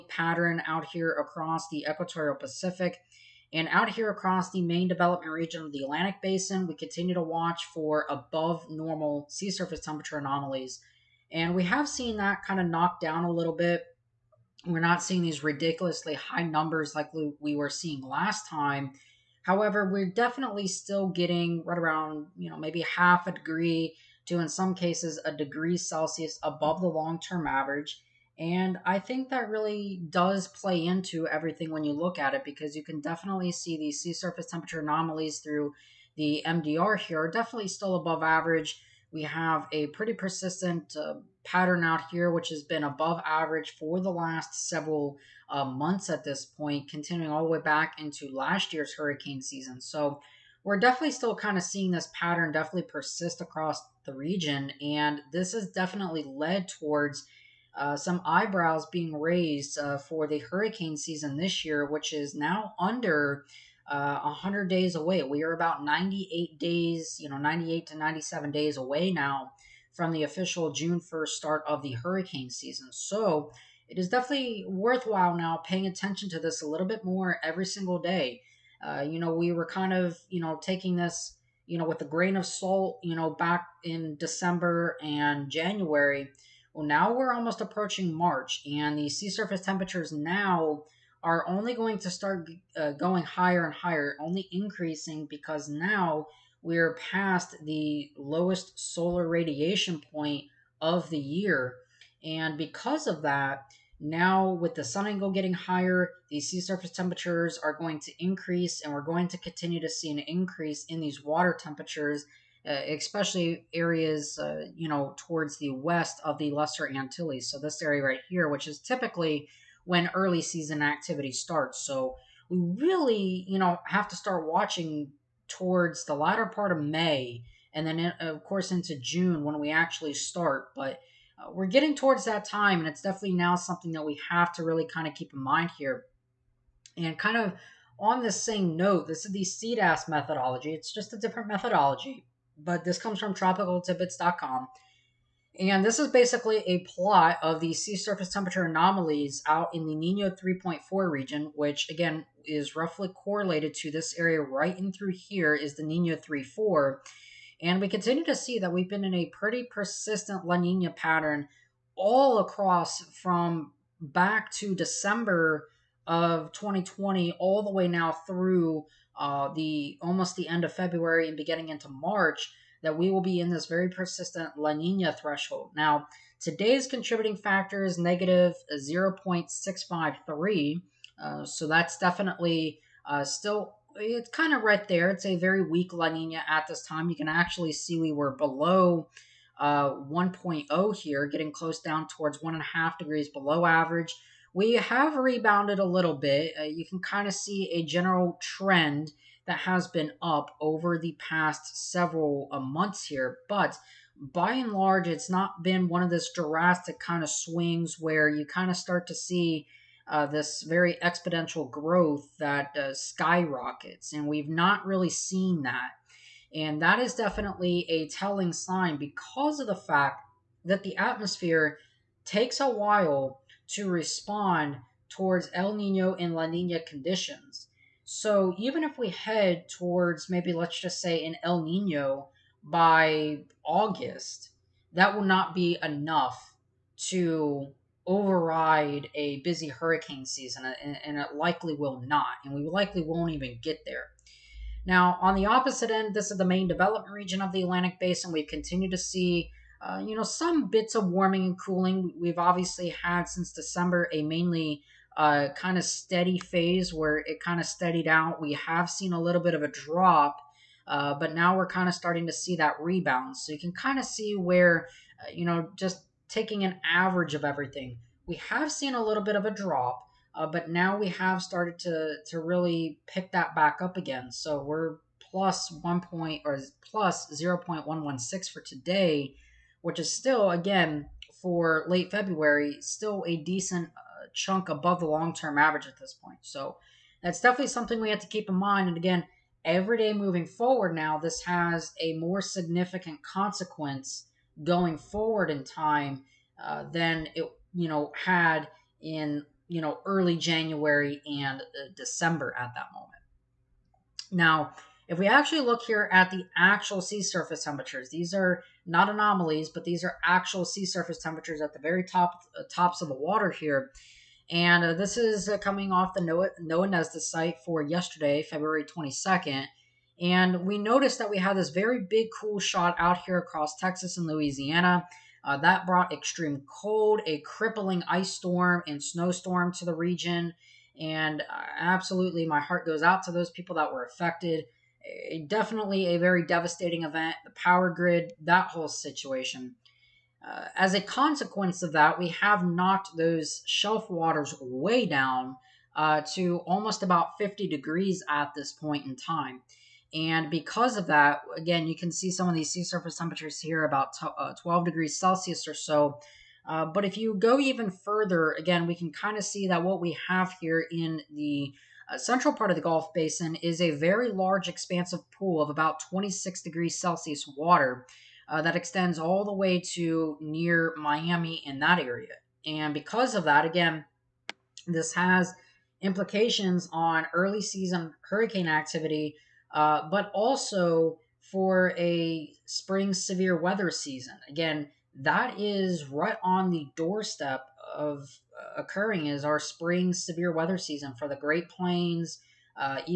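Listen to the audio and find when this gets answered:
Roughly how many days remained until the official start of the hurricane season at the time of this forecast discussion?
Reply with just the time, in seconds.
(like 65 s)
65 s.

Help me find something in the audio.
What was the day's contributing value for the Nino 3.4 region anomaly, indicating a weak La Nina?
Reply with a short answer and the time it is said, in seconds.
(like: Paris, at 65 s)
-0.653, at 177 s.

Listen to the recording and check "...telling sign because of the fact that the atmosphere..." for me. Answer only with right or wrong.
right.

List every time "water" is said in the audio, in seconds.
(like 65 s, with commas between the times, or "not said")
111 s, 313 s, 344 s, 367 s.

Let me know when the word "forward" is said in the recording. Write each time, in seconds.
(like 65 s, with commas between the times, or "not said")
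290 s, 294 s.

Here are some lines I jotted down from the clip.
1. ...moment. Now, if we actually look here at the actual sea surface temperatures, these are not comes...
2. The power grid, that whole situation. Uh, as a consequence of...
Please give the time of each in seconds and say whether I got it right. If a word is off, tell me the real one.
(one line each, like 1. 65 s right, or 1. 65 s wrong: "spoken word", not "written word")
1. 302 s wrong: "anomalies", not "comes"
2. 337 s right.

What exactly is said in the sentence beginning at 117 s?
So this area right here, which is typically when early season activity starts.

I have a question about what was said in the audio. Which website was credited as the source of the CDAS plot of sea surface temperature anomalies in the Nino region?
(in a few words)
tropicaltidbits.com.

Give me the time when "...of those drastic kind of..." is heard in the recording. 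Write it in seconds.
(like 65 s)
206 s.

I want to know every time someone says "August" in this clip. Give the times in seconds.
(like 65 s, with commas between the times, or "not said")
233 s.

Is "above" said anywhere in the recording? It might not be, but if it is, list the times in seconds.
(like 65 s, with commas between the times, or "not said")
8 s, 26 s, 37 s, 42 s, 284 s.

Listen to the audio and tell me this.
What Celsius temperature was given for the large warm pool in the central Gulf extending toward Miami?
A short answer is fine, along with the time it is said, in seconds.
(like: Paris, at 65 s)
26 degrees Celsius, at 366 s.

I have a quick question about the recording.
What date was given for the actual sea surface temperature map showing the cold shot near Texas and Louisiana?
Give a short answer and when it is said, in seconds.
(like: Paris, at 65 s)
February 22nd, at 318 s.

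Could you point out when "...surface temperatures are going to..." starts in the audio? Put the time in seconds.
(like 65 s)
106 s.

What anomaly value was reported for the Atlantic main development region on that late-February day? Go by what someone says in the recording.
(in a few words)
+0.116.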